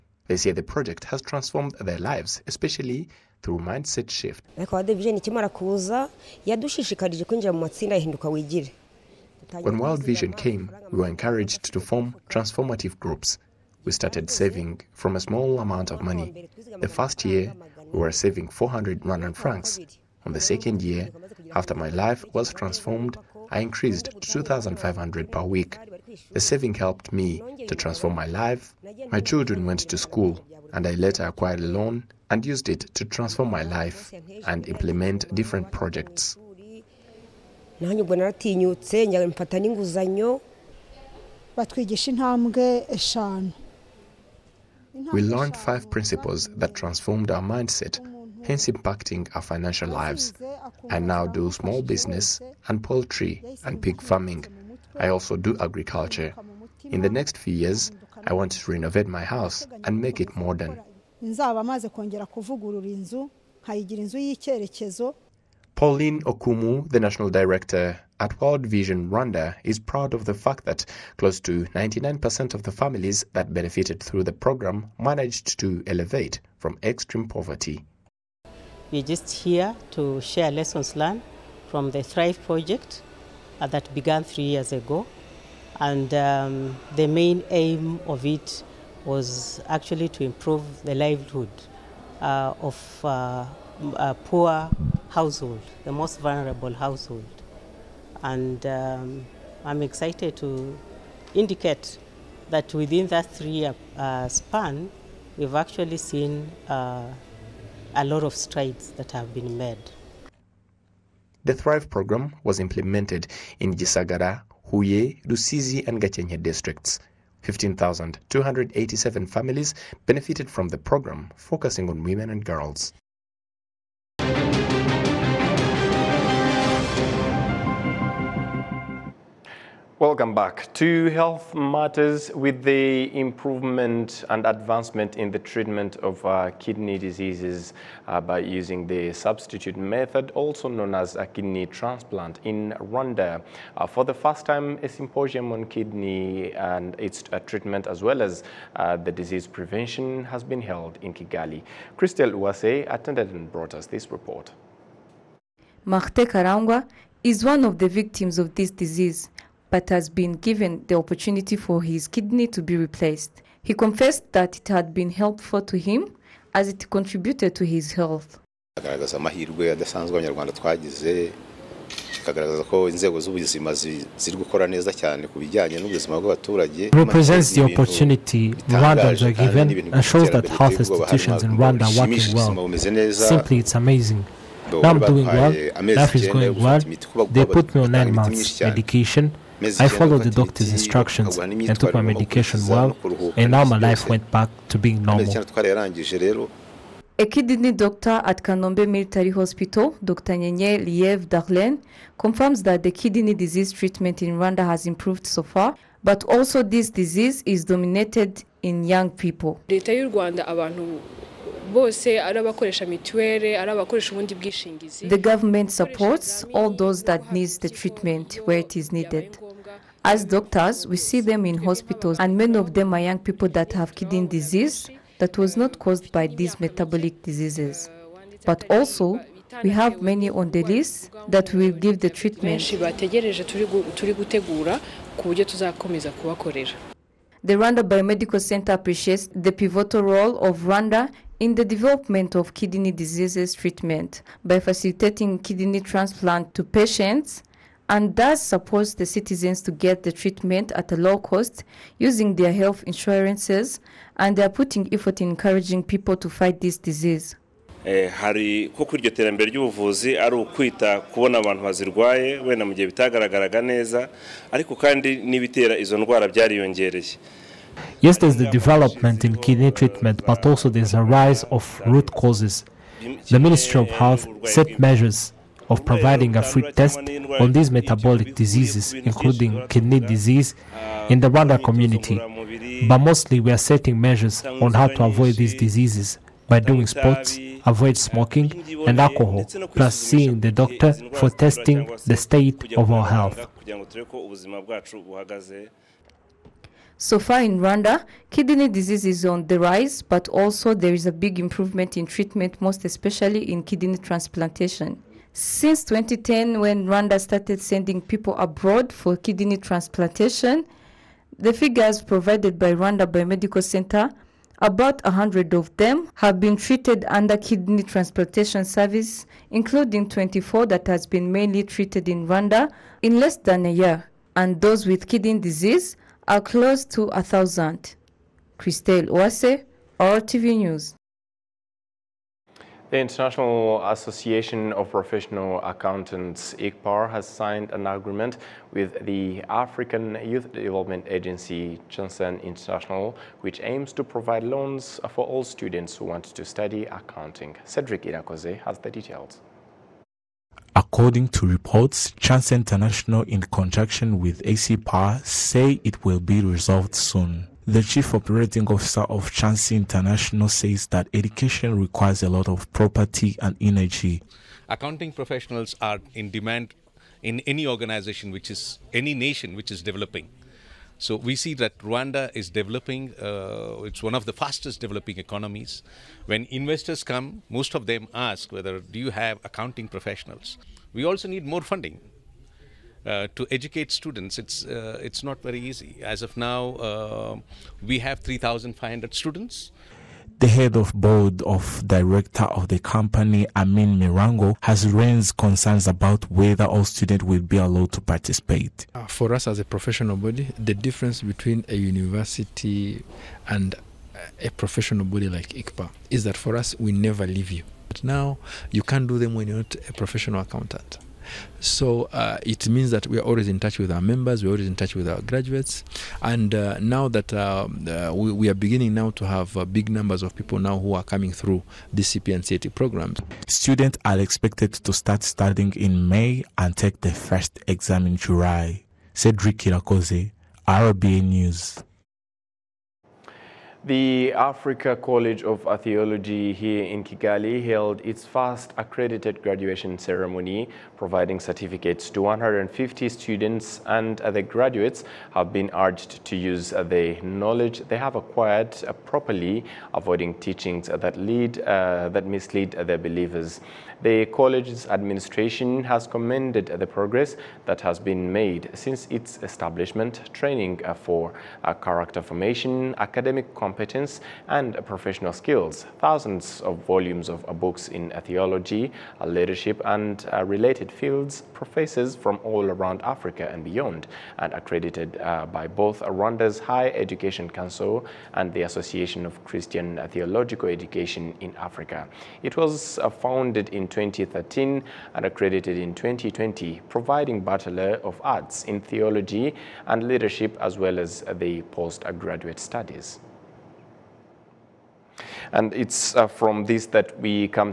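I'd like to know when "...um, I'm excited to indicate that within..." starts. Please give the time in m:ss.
1:38.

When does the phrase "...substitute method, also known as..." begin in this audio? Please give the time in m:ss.
2:19.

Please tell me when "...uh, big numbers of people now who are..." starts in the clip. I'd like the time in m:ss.
6:59.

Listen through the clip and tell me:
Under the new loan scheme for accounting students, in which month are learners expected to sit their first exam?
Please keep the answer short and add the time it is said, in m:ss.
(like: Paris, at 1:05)
July, at 7:08.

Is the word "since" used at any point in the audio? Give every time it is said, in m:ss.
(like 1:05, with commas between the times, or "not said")
5:05, 7:38.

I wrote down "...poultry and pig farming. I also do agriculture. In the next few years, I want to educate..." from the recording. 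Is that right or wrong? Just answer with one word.
wrong.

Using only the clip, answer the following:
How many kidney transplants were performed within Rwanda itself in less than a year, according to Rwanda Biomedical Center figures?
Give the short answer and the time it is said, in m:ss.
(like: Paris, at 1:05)
24, at 5:20.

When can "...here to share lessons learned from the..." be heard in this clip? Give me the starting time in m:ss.
1:19.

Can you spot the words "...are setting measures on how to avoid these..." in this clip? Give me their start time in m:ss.
4:43.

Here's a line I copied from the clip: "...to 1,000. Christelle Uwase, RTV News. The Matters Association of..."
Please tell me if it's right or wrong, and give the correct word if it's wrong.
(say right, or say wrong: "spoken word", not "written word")
wrong: "International", not "Matters".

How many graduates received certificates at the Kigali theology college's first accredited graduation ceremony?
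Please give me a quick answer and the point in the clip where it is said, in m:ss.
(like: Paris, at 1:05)
150, at 7:22.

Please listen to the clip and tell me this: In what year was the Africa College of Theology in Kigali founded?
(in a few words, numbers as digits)
2013.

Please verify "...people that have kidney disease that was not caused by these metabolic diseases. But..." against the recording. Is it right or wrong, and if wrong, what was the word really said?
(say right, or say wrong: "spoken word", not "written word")
right.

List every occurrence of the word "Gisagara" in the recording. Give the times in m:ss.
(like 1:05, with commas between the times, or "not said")
1:53.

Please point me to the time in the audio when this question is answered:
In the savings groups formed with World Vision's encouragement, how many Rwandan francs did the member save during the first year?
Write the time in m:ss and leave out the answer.
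0:18.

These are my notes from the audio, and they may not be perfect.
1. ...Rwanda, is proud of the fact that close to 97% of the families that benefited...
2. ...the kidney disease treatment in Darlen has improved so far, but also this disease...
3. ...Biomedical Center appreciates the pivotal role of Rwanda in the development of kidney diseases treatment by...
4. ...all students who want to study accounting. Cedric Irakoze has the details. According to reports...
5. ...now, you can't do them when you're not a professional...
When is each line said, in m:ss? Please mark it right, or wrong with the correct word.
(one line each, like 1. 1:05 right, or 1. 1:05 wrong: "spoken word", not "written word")
1. 1:09 wrong: "99", not "97"
2. 3:22 wrong: "Rwanda", not "Darlen"
3. 3:57 right
4. 5:45 right
5. 6:48 right.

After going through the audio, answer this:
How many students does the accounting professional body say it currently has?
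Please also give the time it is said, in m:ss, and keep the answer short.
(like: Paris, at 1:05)
3,500, at 6:28.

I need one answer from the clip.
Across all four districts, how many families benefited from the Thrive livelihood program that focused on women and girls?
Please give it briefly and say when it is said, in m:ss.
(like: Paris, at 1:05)
15,287, at 1:57.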